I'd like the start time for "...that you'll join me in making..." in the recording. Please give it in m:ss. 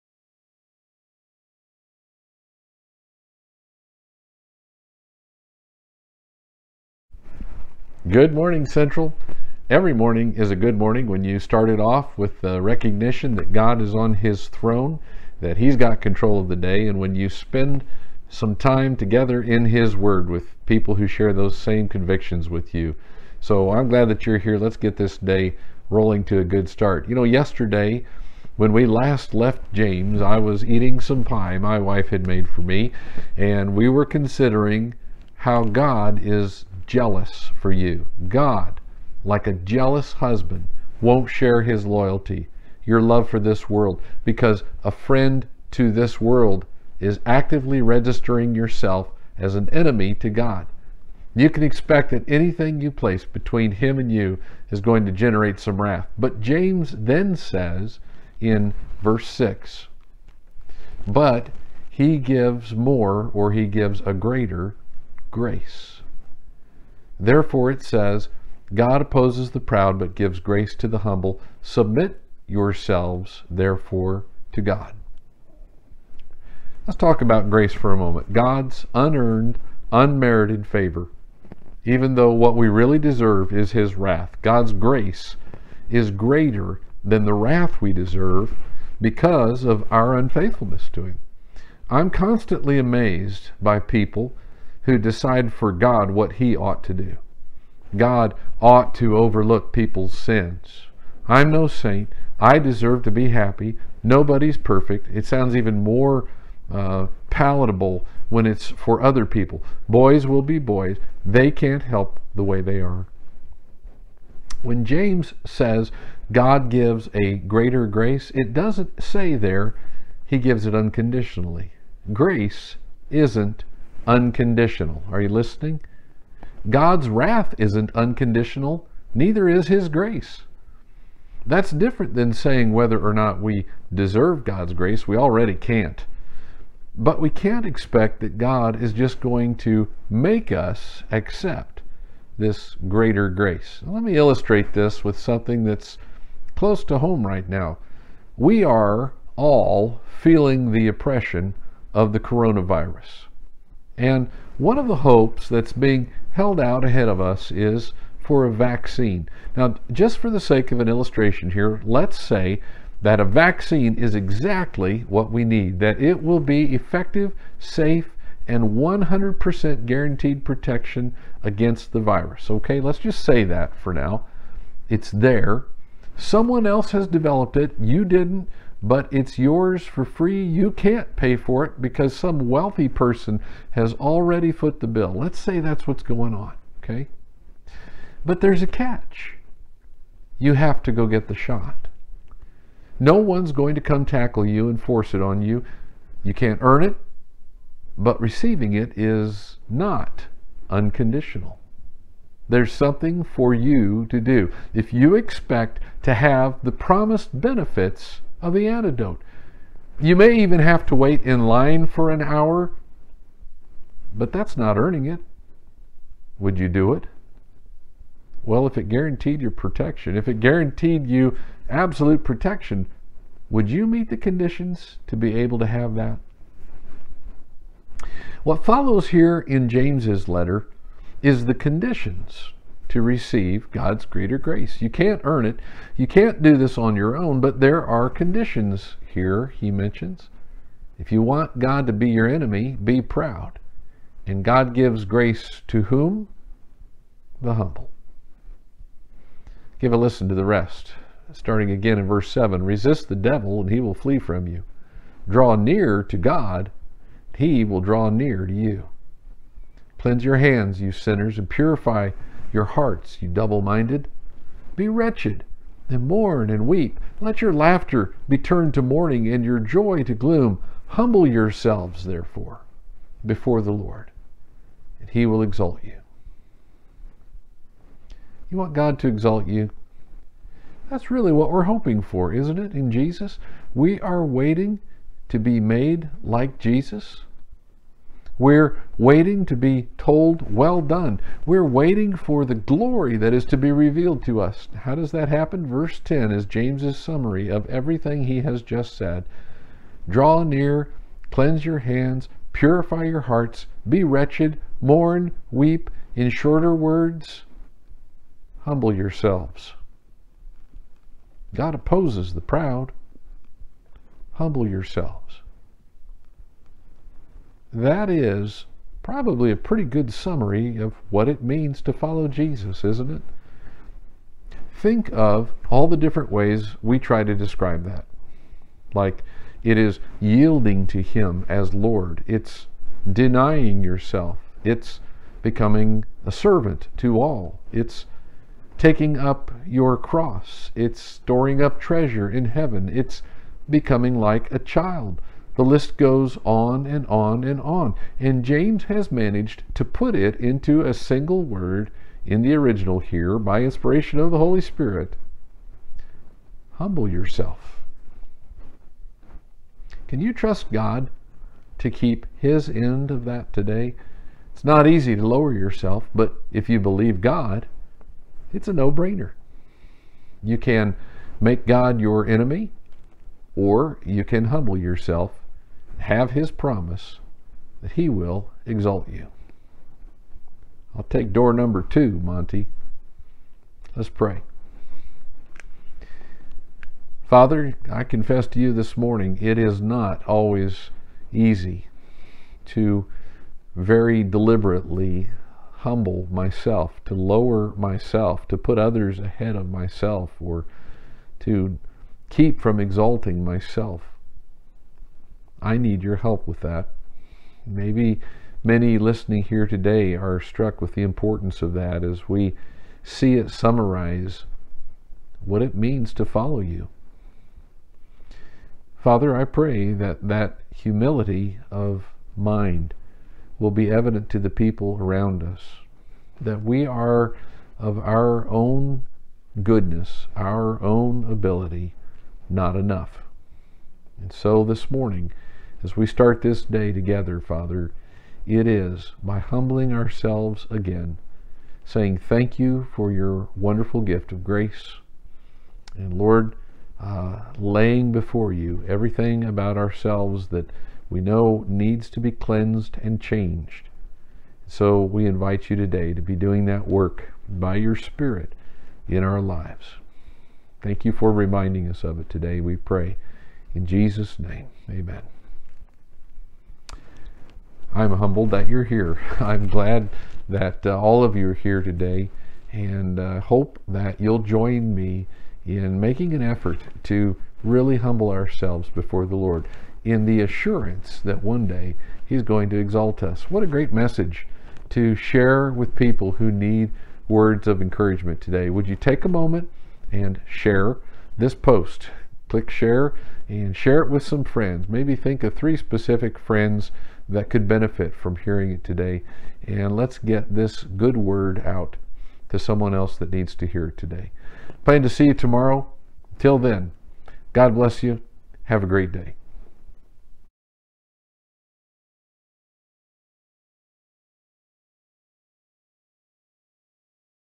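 7:53.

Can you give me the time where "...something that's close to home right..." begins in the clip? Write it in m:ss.
2:25.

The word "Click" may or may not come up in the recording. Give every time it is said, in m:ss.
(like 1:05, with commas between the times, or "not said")
8:12.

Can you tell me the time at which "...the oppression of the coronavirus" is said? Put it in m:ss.
2:30.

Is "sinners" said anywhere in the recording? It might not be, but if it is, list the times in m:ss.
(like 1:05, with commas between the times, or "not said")
4:20.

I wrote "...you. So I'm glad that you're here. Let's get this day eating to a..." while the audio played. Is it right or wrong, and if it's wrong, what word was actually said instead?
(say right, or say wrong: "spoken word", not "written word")
wrong: "rolling", not "eating".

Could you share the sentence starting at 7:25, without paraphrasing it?
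And Lord, uh, laying before you everything about ourselves that we know needs to be cleansed and changed.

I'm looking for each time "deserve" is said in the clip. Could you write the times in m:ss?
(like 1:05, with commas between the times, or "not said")
1:22, 1:27, 1:42, 2:13.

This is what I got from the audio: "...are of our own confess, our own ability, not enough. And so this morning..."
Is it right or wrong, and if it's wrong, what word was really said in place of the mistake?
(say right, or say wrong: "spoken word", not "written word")
wrong: "goodness", not "confess".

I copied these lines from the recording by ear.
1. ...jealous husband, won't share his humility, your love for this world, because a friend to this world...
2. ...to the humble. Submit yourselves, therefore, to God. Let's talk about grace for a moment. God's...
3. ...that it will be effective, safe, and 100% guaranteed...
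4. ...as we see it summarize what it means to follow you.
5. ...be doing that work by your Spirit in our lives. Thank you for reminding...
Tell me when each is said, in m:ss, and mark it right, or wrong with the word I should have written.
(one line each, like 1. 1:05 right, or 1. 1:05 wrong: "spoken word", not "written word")
1. 0:39 wrong: "loyalty", not "humility"
2. 1:10 right
3. 2:45 right
4. 6:52 right
5. 7:36 right.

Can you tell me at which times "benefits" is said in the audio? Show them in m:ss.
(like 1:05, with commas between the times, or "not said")
3:27, 8:17.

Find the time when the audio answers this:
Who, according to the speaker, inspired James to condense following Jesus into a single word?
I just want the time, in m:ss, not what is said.
5:54.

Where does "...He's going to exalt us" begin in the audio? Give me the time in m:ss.
8:02.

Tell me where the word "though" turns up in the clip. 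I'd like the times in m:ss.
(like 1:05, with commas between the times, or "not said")
1:22.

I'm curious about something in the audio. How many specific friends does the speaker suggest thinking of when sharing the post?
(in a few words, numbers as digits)
3.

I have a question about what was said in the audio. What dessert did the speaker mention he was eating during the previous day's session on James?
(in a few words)
Pie.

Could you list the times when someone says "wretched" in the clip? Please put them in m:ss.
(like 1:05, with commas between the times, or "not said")
4:24, 5:04.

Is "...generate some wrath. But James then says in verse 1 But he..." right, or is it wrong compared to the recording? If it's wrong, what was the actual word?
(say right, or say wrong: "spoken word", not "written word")
wrong: "6", not "1".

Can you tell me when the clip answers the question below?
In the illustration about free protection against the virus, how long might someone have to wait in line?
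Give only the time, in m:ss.
3:32.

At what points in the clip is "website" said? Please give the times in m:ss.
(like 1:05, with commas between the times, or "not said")
not said.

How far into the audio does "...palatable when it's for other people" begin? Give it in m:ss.
1:47.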